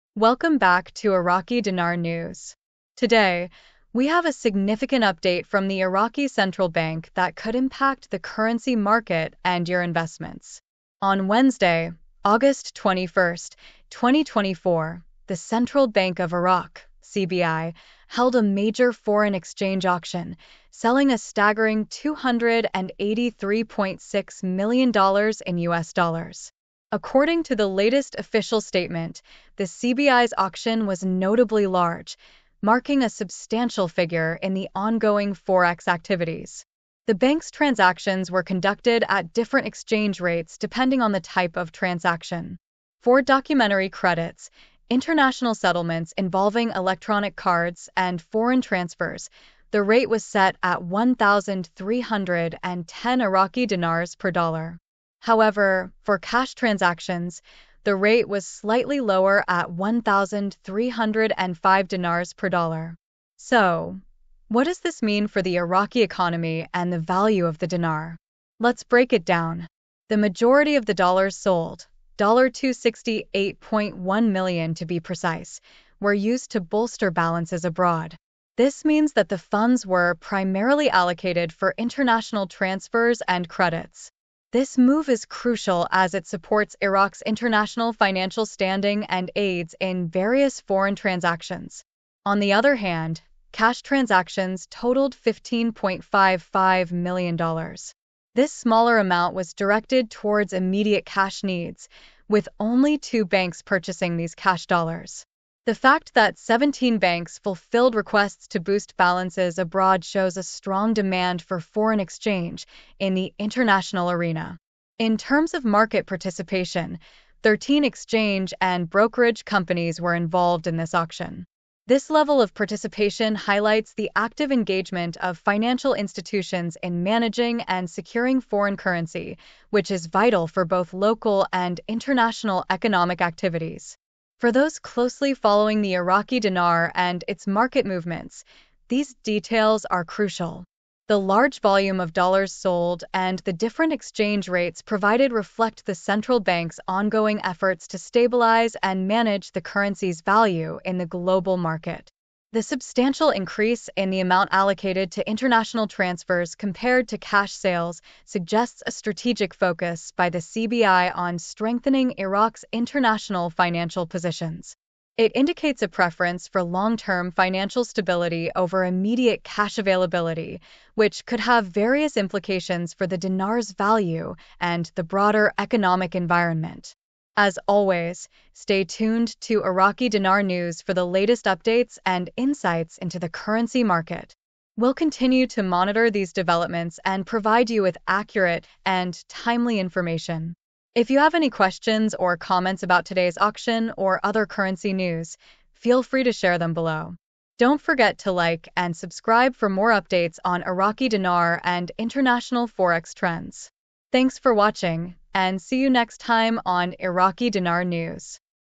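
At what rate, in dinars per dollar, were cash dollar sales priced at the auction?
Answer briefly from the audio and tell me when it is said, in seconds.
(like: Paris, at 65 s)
1,305, at 59 s.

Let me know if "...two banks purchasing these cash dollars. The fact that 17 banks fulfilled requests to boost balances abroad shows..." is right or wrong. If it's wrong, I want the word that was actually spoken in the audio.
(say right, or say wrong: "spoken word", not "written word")
right.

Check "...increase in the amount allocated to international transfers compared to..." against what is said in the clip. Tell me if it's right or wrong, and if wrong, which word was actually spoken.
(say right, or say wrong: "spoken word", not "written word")
right.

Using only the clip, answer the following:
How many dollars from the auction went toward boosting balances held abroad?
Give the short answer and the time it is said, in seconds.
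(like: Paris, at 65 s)
$268.1 million, at 72 s.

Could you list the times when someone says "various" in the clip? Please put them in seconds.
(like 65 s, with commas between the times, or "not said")
90 s, 171 s.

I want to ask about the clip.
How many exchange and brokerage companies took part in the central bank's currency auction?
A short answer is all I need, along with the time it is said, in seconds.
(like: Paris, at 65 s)
13, at 117 s.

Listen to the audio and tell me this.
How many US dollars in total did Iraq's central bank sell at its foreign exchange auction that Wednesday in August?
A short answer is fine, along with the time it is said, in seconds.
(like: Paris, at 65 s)
$283.6 million, at 21 s.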